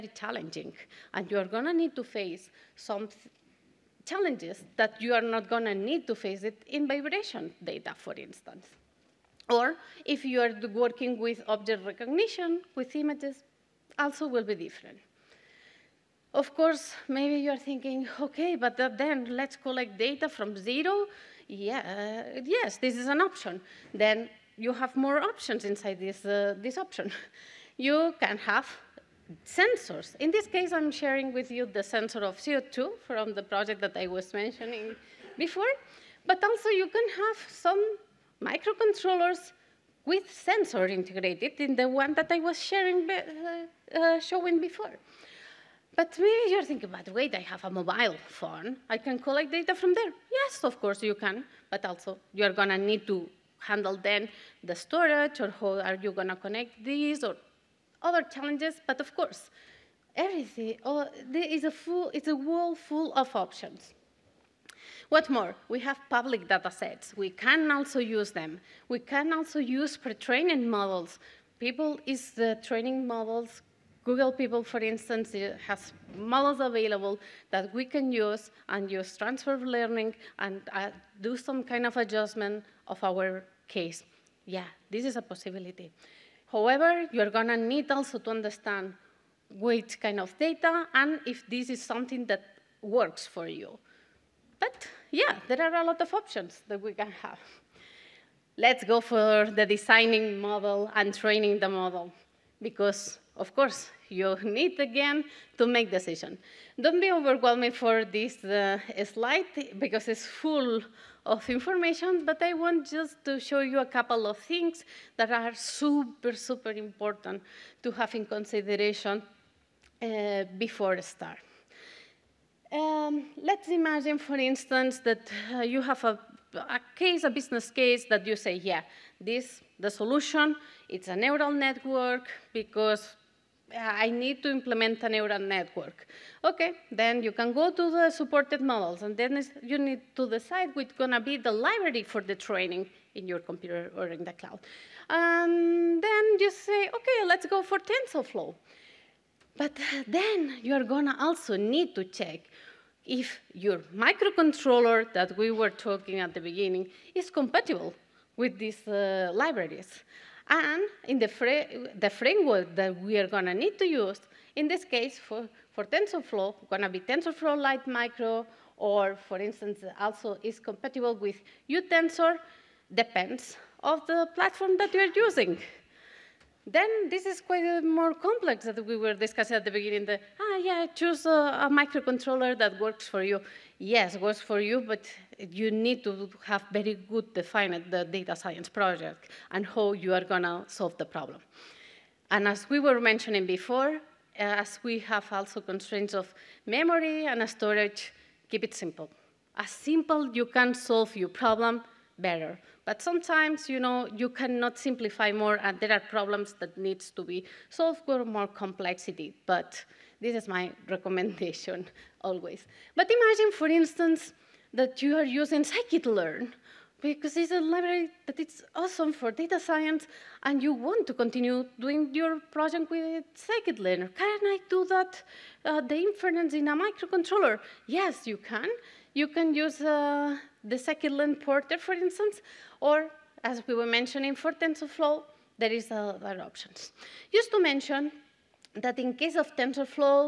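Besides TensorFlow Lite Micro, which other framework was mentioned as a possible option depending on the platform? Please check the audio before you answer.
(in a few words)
uTensor.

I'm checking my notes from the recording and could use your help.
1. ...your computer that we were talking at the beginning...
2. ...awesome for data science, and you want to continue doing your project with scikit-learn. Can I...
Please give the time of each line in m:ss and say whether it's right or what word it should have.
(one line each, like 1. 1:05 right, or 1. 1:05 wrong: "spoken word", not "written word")
1. 2:33 wrong: "microcontroller", not "computer"
2. 3:38 right.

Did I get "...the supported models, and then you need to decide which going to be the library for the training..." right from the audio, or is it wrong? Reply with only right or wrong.
right.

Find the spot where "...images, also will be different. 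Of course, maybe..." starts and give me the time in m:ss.
0:12.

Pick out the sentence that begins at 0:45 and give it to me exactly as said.
But maybe you're thinking, but wait, I have a mobile phone.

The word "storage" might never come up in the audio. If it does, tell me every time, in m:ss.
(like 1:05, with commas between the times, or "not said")
0:54, 3:17.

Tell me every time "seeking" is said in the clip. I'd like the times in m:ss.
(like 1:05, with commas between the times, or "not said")
not said.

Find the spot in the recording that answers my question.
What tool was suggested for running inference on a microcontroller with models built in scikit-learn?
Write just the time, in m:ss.
3:50.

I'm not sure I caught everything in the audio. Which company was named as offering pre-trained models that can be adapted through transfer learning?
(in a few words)
Google.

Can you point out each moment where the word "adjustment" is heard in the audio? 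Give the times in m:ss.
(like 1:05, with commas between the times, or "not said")
1:21.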